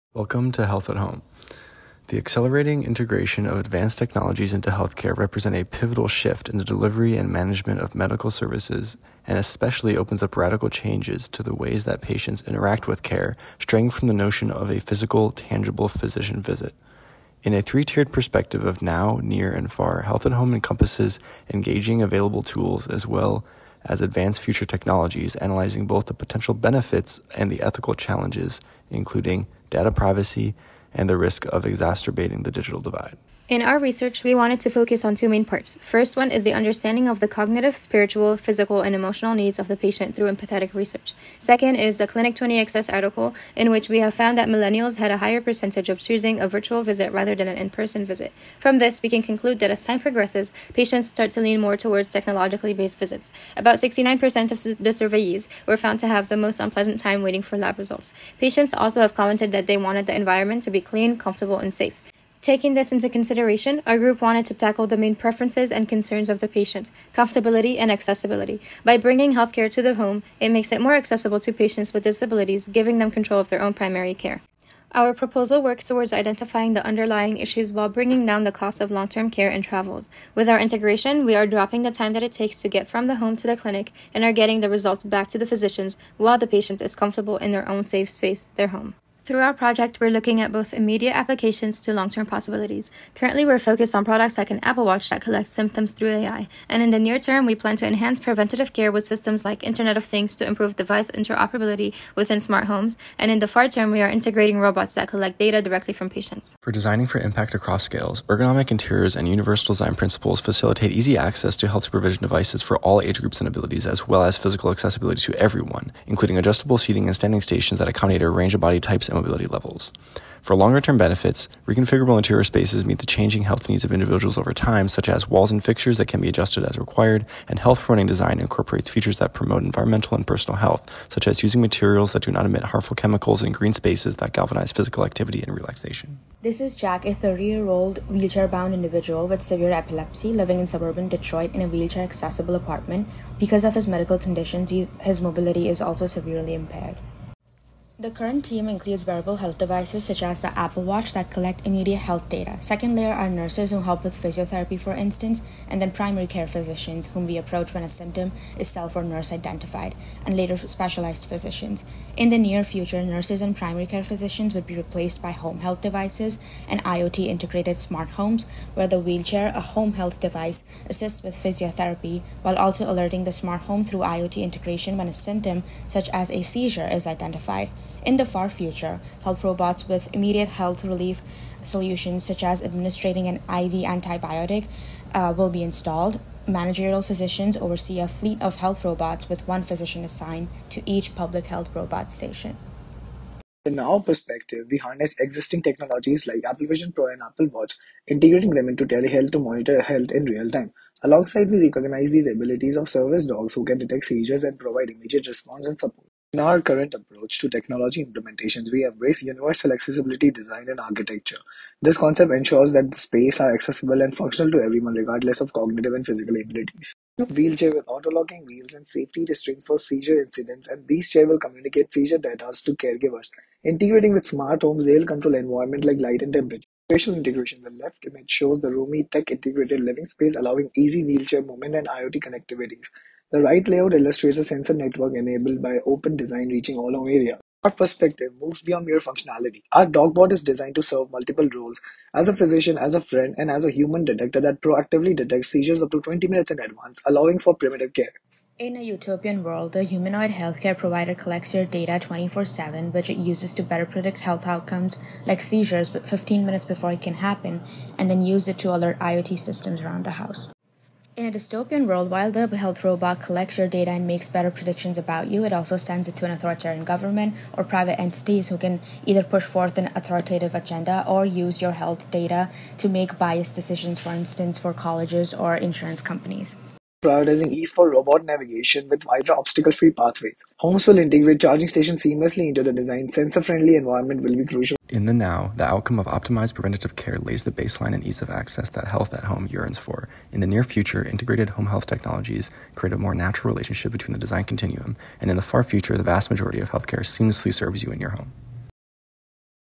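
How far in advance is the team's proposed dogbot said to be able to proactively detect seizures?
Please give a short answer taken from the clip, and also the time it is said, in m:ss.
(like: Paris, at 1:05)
20 minutes, at 4:06.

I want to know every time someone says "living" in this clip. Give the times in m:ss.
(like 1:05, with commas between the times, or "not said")
2:20, 3:49.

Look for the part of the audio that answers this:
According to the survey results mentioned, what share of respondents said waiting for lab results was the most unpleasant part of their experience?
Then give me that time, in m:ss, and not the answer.
0:53.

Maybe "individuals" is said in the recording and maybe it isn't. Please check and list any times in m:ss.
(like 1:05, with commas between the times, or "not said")
2:03, 2:18.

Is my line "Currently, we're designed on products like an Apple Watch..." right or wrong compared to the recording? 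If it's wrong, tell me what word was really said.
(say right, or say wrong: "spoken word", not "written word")
wrong: "focused", not "designed".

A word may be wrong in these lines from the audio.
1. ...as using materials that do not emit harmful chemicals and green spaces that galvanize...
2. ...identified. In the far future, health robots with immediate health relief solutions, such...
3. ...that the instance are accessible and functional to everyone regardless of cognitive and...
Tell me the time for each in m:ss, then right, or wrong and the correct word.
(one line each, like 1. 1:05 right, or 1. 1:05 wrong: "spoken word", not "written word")
1. 2:11 right
2. 2:57 right
3. 3:32 wrong: "space", not "instance".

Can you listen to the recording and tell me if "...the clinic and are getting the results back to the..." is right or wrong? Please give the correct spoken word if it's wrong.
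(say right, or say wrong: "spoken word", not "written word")
right.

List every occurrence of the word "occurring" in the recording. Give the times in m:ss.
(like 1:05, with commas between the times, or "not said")
not said.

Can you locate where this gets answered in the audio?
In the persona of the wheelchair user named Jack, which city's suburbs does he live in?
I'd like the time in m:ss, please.
2:21.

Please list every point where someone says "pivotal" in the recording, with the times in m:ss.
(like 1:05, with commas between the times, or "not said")
0:05.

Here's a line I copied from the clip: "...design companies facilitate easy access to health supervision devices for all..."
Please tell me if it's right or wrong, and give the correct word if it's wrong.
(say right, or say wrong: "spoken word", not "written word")
wrong: "principles", not "companies".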